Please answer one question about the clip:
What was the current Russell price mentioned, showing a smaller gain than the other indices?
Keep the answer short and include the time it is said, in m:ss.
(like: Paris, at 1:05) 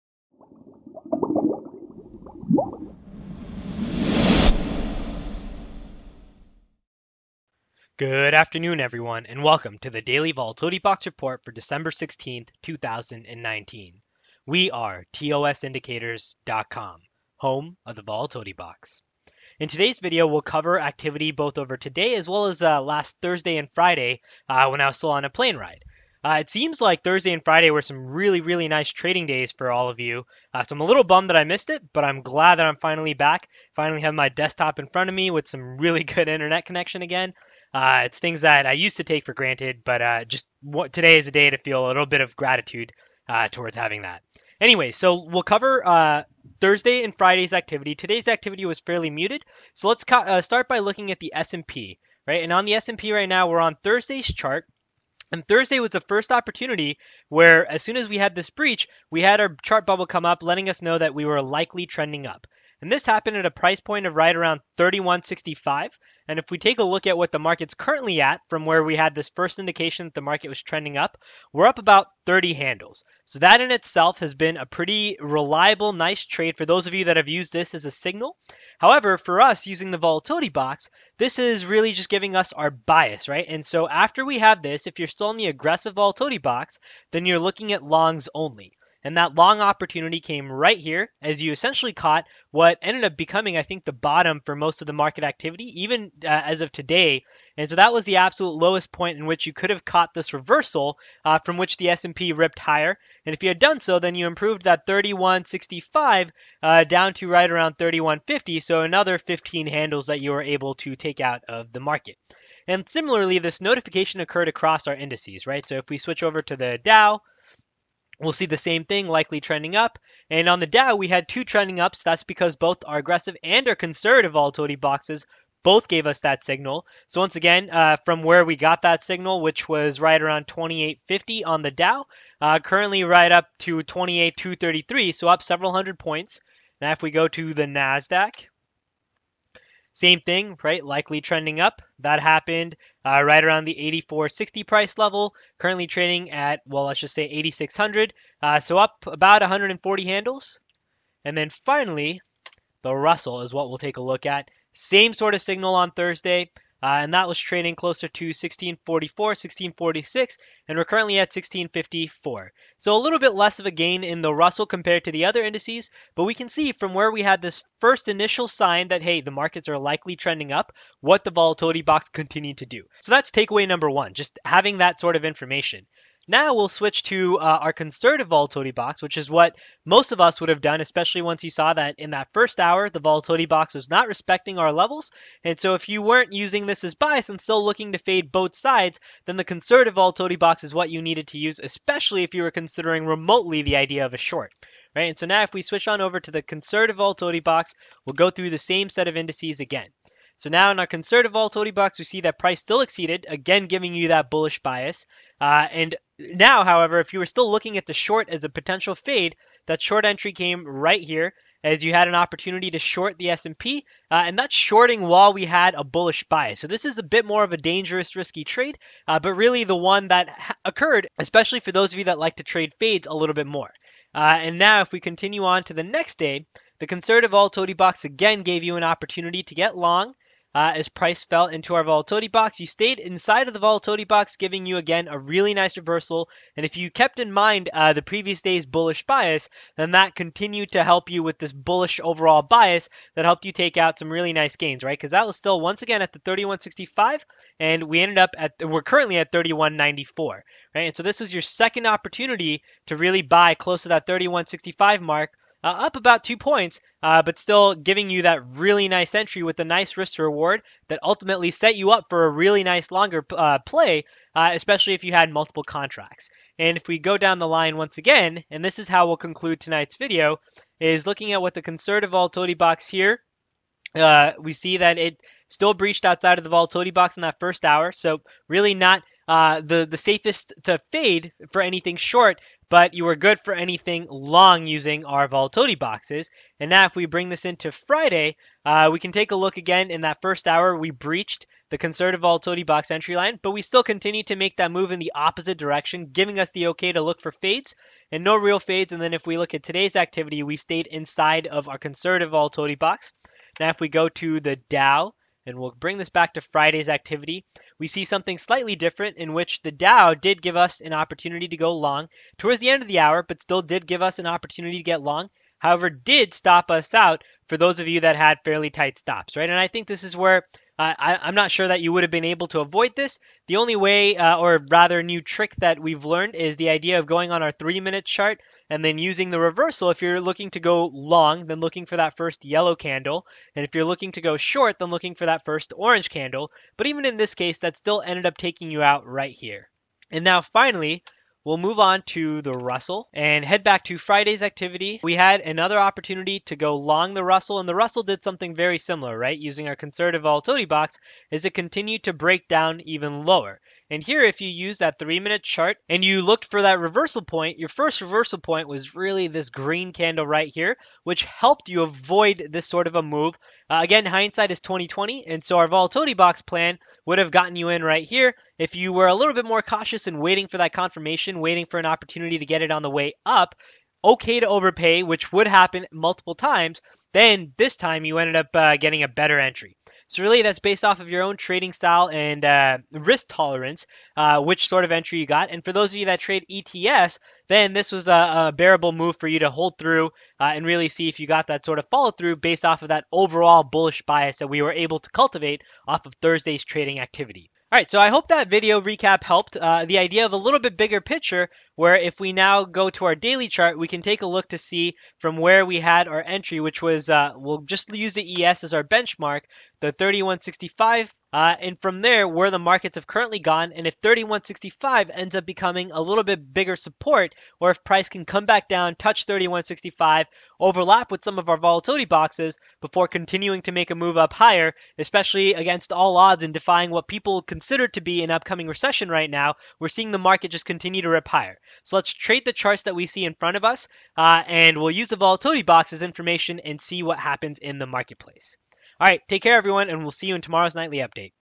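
1654, at 2:41.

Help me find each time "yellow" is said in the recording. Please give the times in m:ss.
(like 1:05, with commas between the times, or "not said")
5:32.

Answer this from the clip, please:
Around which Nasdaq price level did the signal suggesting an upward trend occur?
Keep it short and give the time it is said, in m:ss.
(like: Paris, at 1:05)
84.60, at 2:24.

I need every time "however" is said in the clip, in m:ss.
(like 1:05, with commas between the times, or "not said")
1:18, 3:26, 5:15.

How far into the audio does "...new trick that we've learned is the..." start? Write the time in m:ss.
5:25.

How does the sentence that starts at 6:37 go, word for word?
All right, so I hope that video recap helped.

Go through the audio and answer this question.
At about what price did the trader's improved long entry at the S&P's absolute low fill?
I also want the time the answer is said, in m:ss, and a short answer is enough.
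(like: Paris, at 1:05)
31.50, at 1:47.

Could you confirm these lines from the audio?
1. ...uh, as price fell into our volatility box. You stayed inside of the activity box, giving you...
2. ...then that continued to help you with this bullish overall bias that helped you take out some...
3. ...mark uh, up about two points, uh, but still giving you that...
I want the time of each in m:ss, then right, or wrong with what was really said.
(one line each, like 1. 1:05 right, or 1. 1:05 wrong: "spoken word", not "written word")
1. 3:50 wrong: "volatility", not "activity"
2. 3:59 right
3. 4:15 right.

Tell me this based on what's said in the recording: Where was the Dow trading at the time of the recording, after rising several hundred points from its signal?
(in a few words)
28233.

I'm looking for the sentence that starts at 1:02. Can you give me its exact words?
And this happened at a price point of right around 31.65.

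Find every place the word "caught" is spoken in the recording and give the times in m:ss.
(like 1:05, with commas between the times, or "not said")
1:31, 1:39.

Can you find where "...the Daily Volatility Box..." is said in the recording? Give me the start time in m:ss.
0:09.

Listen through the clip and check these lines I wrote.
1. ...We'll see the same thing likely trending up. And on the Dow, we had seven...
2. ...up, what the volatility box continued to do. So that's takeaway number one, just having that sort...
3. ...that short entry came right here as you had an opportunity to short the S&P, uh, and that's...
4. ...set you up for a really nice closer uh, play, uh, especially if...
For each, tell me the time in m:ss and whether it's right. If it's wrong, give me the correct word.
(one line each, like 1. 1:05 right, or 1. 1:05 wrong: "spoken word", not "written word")
1. 1:58 wrong: "two", not "seven"
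2. 2:50 right
3. 3:29 right
4. 4:21 wrong: "longer", not "closer".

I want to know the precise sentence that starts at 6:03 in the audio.
Uh, again, hindsight is 2020, and so our volatility box plan would have gotten you in right here.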